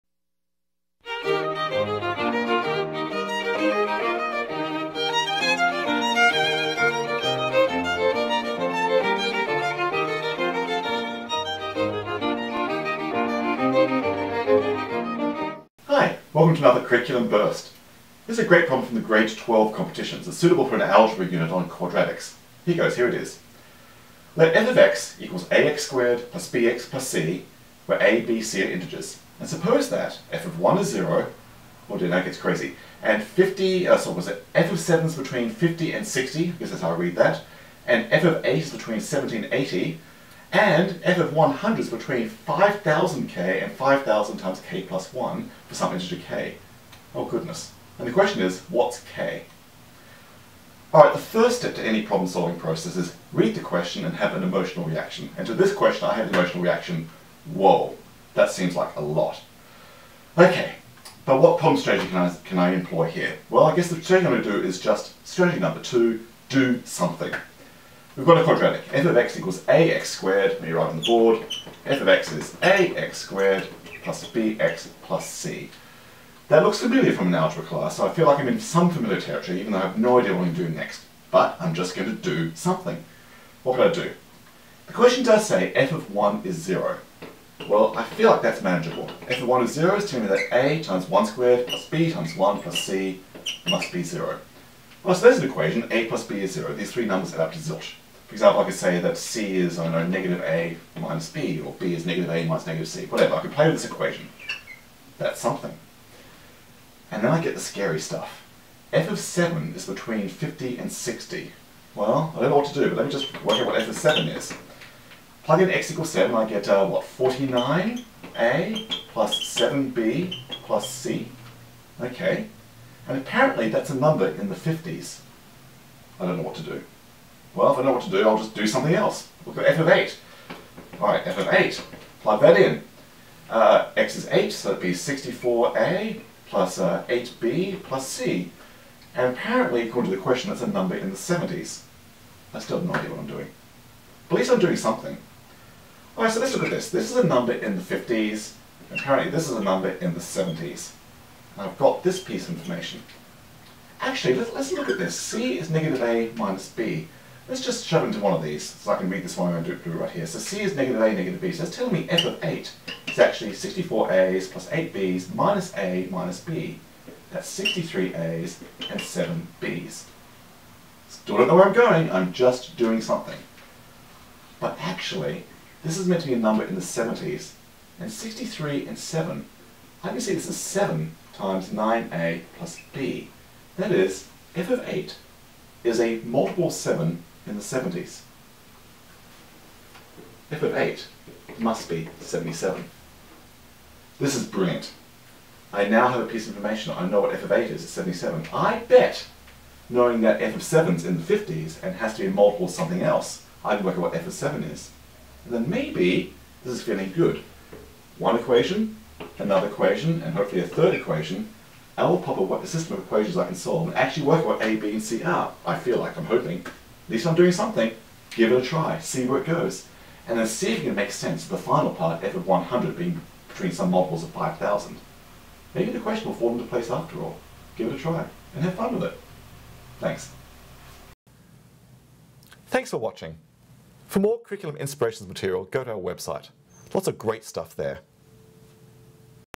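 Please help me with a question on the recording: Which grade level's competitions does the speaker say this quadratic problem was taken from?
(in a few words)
grade 12.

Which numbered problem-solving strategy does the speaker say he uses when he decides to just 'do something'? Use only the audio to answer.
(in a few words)
2.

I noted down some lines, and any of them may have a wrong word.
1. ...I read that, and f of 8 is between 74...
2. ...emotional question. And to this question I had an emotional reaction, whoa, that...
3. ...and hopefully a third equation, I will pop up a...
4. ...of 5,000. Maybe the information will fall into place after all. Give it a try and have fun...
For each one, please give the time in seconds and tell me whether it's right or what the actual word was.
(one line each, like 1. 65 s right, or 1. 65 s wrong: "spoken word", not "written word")
1. 36 s wrong: "70", not "74"
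2. 54 s wrong: "reaction", not "question"
3. 210 s right
4. 224 s wrong: "question", not "information".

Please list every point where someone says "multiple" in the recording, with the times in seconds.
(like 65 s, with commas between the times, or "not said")
186 s, 202 s, 223 s.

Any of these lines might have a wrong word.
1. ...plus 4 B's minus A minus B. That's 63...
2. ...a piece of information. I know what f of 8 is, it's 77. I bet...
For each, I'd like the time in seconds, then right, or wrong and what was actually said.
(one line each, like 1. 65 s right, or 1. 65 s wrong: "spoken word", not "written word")
1. 164 s wrong: "8", not "4"
2. 196 s right.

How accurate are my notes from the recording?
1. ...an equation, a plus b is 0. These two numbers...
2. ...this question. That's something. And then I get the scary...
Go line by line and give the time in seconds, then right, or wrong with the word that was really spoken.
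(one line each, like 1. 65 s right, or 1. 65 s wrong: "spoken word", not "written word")
1. 95 s wrong: "three", not "two"
2. 103 s wrong: "equation", not "question".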